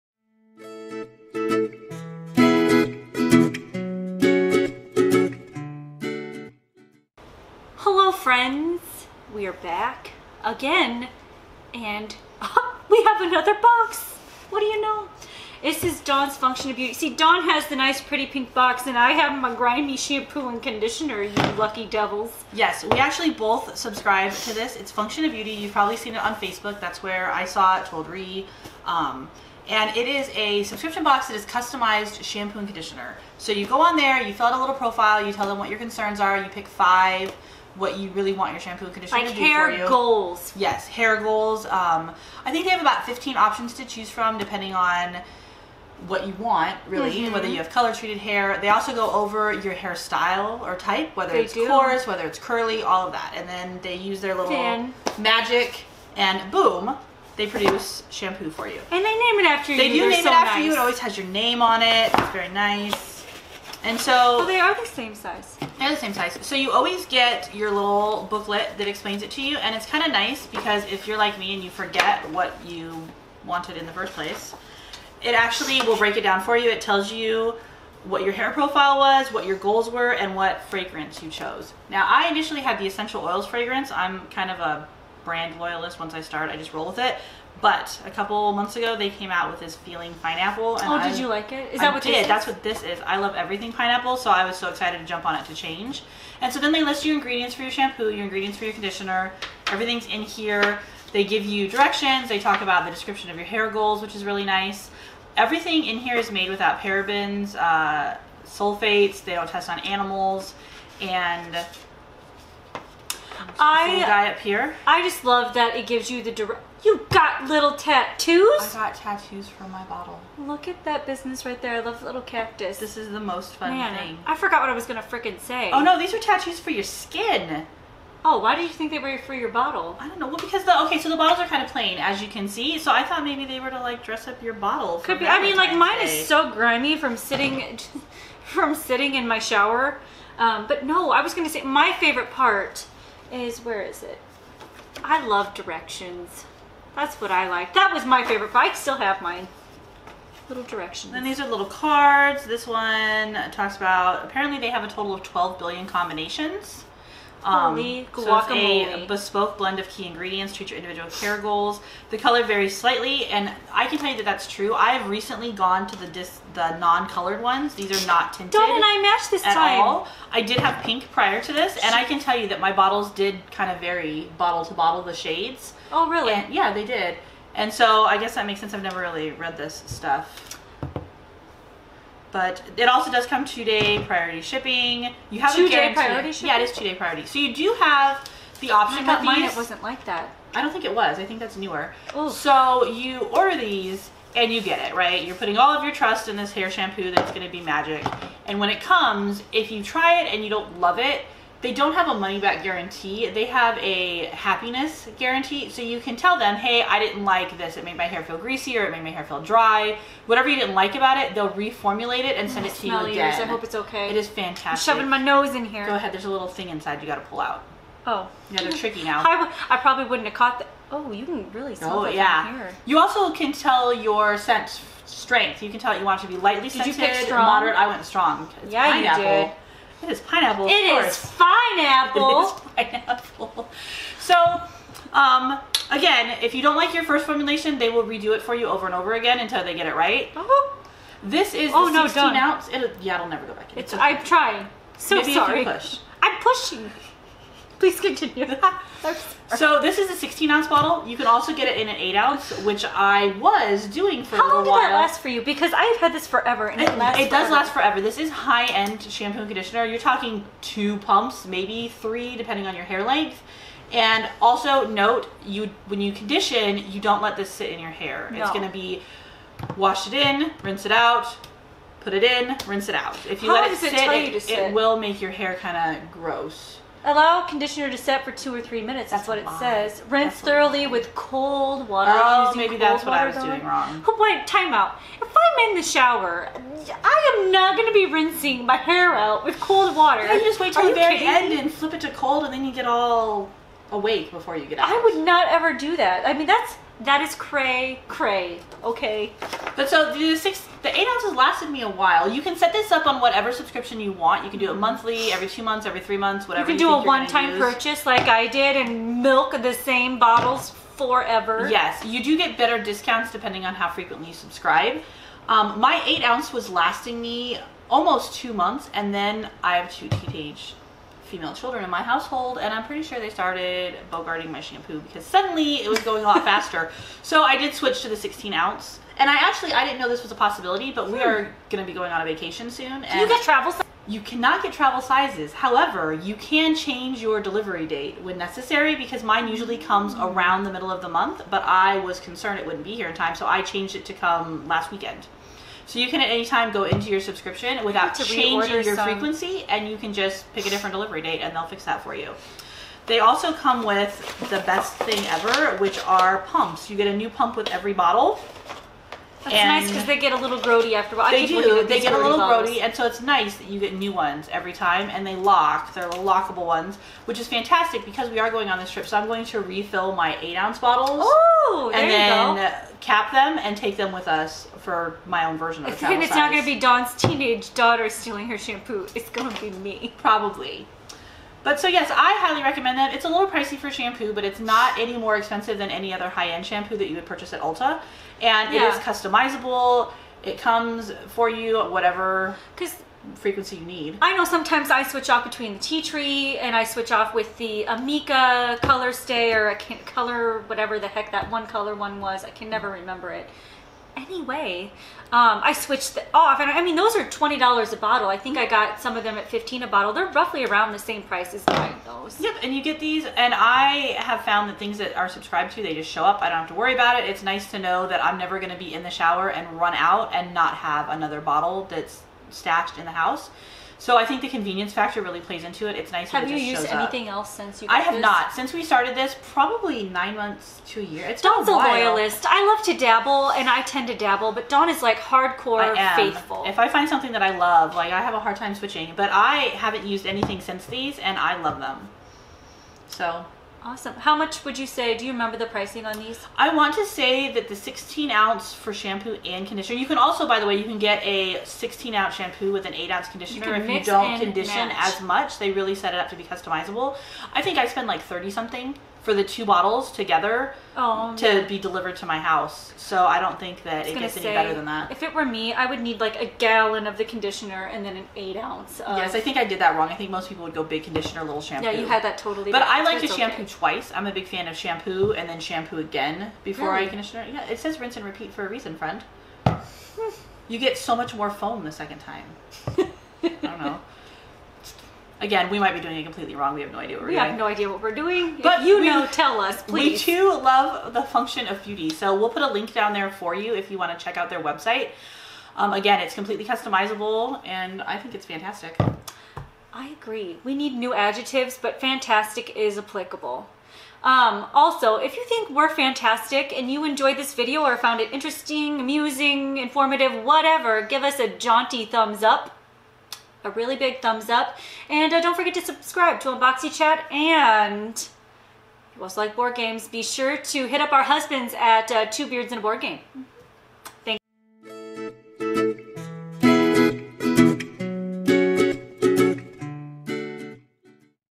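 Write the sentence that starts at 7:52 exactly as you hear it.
But I like to shampoo okay.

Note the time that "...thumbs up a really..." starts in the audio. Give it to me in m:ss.
8:32.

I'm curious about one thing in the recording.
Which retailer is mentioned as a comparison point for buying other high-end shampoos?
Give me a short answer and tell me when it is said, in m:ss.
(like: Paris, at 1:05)
Ulta, at 6:27.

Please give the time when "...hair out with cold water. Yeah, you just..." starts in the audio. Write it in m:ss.
4:48.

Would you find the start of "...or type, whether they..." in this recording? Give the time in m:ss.
0:50.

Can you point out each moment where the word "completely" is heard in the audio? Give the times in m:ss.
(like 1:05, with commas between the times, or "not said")
8:06, 8:16.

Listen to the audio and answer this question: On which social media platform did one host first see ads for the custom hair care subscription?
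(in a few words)
Facebook.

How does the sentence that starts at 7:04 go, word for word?
So I think the convenience factor really plays into it.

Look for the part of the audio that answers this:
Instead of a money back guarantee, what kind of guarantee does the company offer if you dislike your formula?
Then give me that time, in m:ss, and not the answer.
3:24.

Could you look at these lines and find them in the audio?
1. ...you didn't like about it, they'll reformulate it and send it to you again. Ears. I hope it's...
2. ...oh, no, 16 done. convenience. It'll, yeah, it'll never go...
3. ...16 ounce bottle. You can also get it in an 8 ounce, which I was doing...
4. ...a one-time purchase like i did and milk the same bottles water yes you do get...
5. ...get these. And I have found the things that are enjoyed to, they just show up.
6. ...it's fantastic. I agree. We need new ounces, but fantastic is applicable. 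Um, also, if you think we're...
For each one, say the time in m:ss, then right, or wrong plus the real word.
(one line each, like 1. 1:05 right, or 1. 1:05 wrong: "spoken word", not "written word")
1. 3:30 right
2. 4:01 wrong: "ounce", not "convenience"
3. 4:10 right
4. 5:07 wrong: "forever", not "water"
5. 6:52 wrong: "subscribed", not "enjoyed"
6. 8:18 wrong: "adjectives", not "ounces".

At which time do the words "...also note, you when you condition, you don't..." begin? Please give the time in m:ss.
4:24.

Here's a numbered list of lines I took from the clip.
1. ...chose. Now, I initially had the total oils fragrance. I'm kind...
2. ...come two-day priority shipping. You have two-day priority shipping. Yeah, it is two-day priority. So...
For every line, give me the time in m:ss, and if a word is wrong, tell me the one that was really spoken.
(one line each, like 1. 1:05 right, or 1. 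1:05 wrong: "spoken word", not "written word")
1. 1:21 wrong: "essential", not "total"
2. 3:03 right.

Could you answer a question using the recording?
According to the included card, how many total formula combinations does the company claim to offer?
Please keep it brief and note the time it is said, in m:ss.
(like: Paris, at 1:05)
12 billion, at 2:35.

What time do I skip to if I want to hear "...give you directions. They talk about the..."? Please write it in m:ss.
1:41.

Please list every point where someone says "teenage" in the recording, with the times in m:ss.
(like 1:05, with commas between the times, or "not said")
5:20, 6:17.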